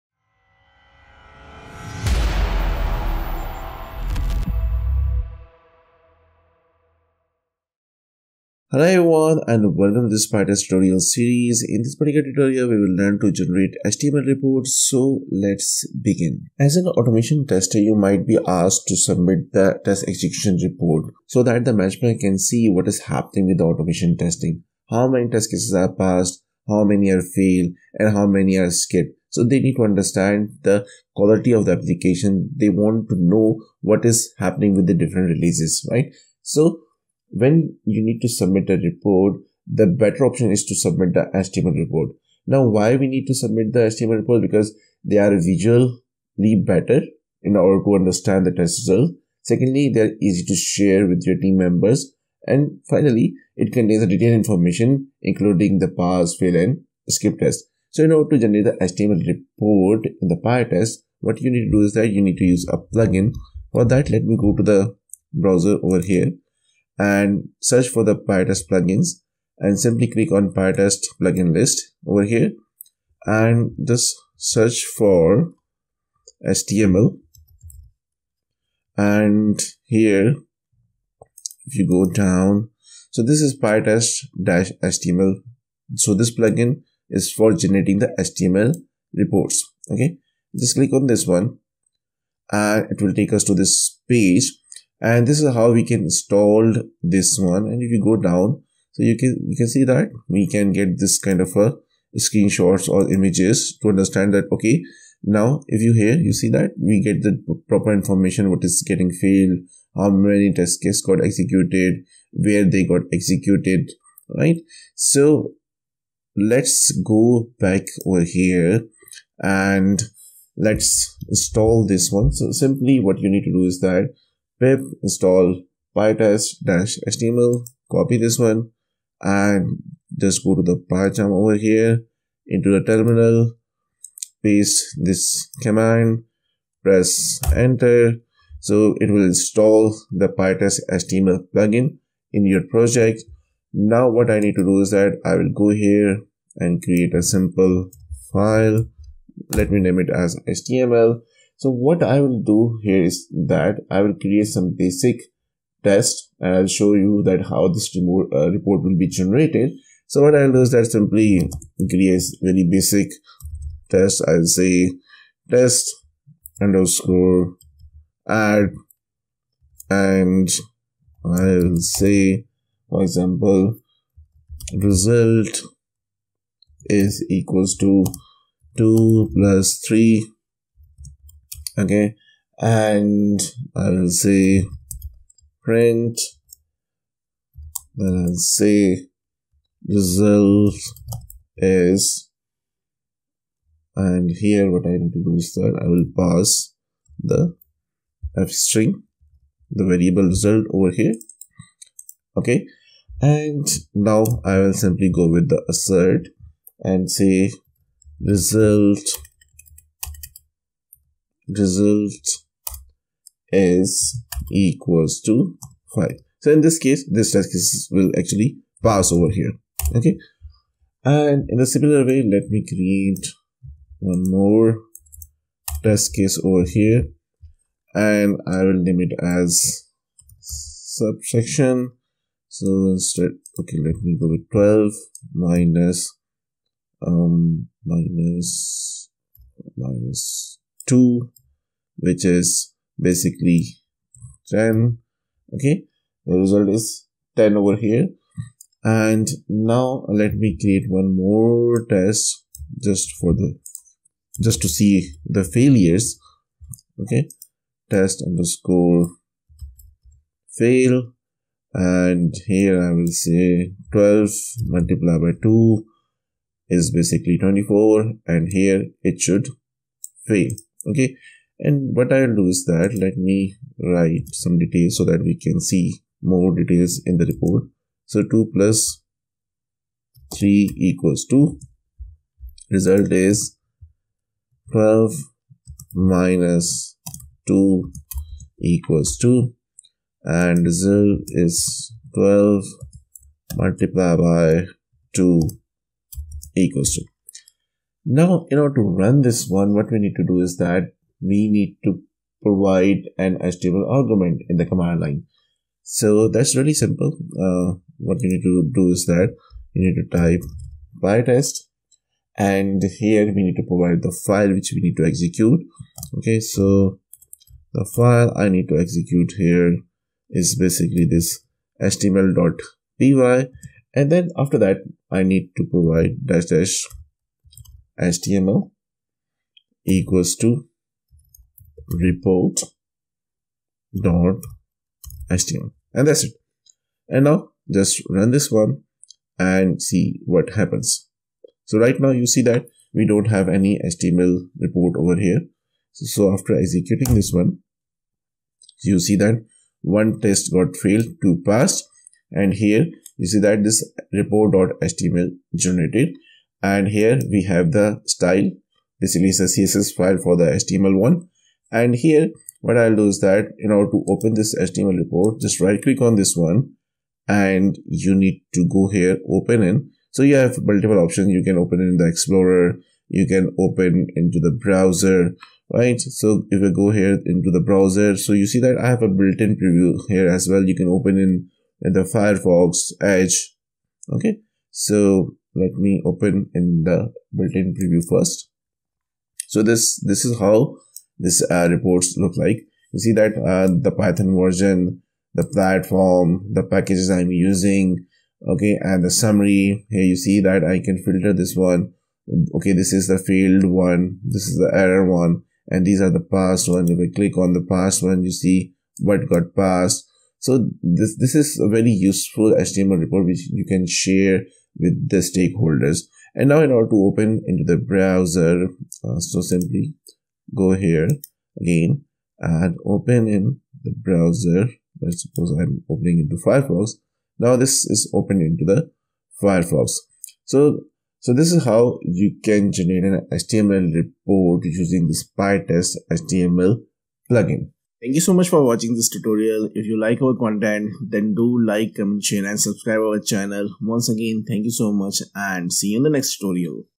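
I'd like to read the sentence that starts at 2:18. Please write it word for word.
So it will install the PyTest HTML plugin in your project.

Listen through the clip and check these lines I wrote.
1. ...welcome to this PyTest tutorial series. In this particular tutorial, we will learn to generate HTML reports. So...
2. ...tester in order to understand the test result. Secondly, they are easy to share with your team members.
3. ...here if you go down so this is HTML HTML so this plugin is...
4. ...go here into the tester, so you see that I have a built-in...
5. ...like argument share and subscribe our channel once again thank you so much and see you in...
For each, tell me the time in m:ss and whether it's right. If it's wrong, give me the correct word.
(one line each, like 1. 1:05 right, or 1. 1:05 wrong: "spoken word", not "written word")
1. 0:09 right
2. 0:46 wrong: "better", not "tester"
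3. 1:19 wrong: "PyTest", not "HTML"
4. 6:16 wrong: "browser", not "tester"
5. 7:21 wrong: "comment", not "argument".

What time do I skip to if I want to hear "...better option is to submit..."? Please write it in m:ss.
0:39.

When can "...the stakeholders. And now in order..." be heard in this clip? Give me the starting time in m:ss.
6:55.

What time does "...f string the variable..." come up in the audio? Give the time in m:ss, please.
3:18.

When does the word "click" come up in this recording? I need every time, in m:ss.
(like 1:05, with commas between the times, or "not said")
1:10, 1:30, 6:05, 6:47.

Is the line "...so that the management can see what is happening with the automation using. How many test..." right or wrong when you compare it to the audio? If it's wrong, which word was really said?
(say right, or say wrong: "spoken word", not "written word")
wrong: "testing", not "using".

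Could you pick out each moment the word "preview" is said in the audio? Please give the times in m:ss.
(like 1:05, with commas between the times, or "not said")
6:19, 6:27.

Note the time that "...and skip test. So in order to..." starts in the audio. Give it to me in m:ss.
0:56.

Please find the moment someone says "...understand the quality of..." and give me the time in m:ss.
0:29.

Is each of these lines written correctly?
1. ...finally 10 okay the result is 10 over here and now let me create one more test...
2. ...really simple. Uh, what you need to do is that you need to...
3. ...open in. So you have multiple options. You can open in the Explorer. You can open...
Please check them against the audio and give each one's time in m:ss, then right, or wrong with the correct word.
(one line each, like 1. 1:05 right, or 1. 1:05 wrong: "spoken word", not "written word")
1. 4:03 wrong: "basically", not "finally"
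2. 5:06 right
3. 6:09 right.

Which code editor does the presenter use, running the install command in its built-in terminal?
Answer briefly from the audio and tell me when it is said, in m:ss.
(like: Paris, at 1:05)
PyCharm, at 2:10.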